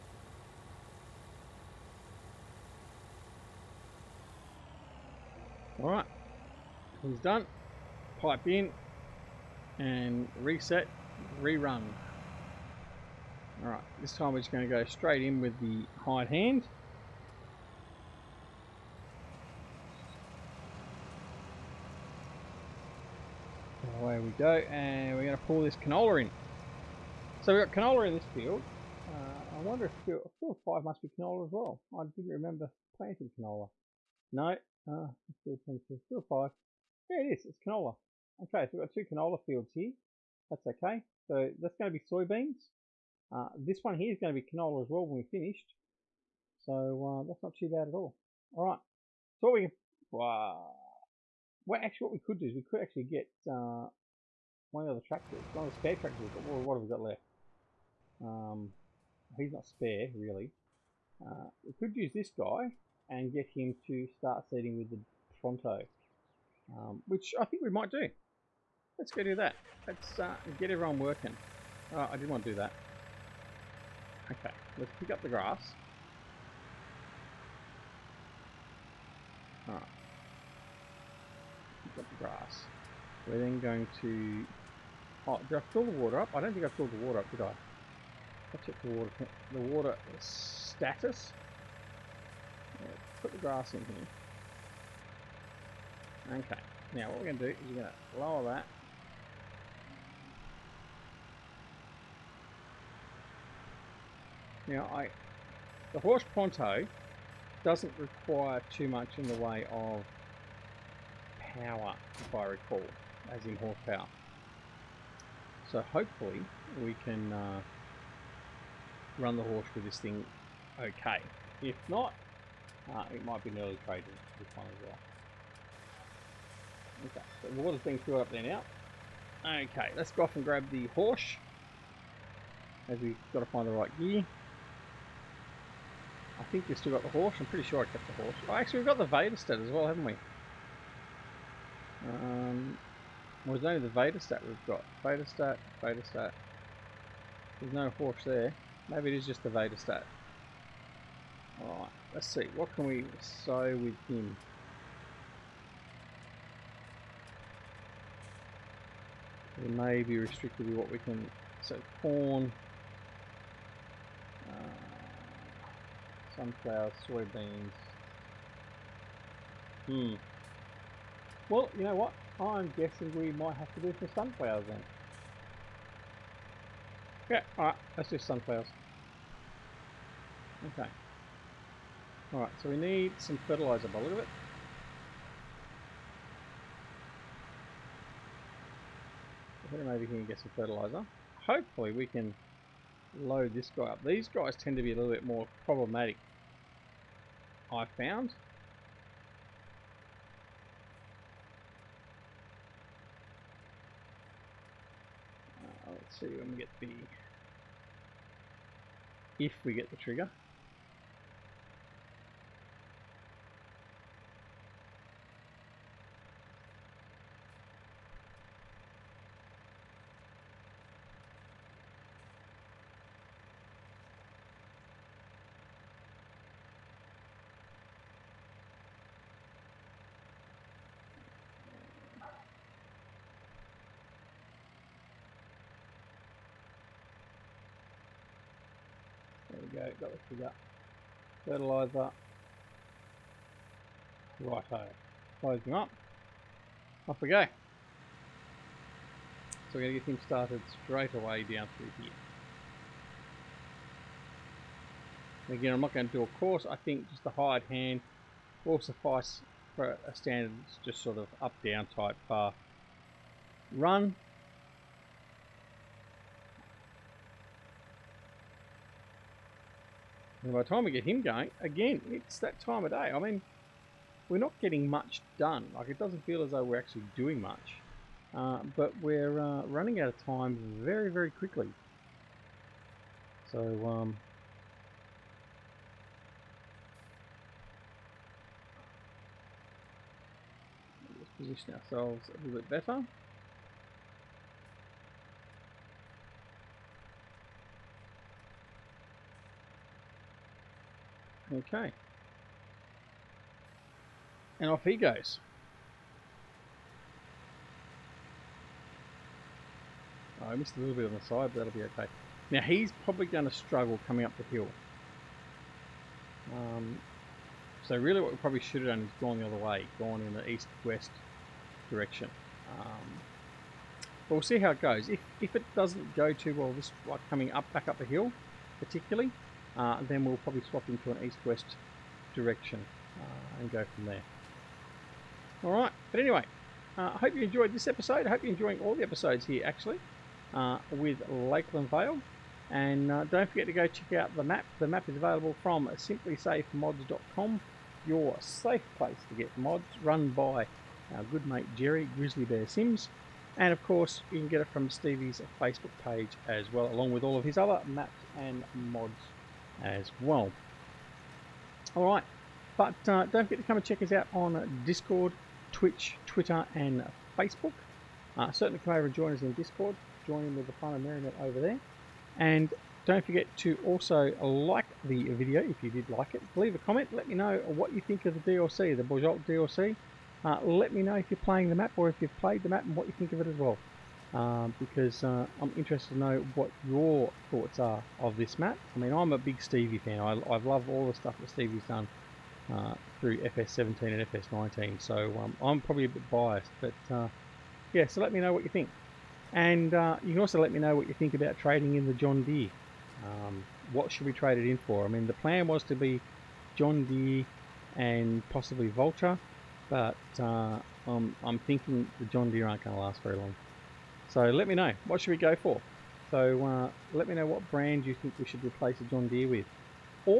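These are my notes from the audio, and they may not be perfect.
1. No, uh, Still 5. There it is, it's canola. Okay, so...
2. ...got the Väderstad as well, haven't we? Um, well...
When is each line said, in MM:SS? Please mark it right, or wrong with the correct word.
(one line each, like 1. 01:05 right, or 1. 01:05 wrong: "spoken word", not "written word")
1. 00:34 right
2. 02:18 right.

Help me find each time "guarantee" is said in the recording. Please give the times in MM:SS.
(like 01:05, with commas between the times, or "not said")
not said.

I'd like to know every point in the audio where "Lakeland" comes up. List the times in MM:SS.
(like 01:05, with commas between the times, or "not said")
05:41.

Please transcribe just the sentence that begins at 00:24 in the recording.
Away we go, and we're going to pull this canola in.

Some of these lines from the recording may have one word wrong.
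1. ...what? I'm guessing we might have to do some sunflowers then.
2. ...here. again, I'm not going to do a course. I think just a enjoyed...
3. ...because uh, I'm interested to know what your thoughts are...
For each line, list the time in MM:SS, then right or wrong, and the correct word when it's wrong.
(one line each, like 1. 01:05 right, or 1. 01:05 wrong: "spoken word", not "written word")
1. 02:51 right
2. 04:12 wrong: "hired", not "enjoyed"
3. 06:24 right.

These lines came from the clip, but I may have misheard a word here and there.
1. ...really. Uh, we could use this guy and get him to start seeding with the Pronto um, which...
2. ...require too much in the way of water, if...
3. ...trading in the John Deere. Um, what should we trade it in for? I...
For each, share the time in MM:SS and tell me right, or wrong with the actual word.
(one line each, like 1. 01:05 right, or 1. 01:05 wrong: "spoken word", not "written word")
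1. 01:00 right
2. 01:47 wrong: "power", not "water"
3. 06:41 right.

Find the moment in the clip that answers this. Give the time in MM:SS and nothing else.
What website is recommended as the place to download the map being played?
05:45.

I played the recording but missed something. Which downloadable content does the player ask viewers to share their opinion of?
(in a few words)
Bojolt DLC.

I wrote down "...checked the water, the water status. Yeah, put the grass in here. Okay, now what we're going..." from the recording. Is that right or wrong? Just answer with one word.
right.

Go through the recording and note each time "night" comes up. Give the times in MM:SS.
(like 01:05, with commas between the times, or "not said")
not said.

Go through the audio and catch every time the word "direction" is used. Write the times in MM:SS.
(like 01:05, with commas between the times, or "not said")
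05:21, 05:32.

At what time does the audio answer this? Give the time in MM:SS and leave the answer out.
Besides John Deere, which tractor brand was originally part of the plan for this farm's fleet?
06:48.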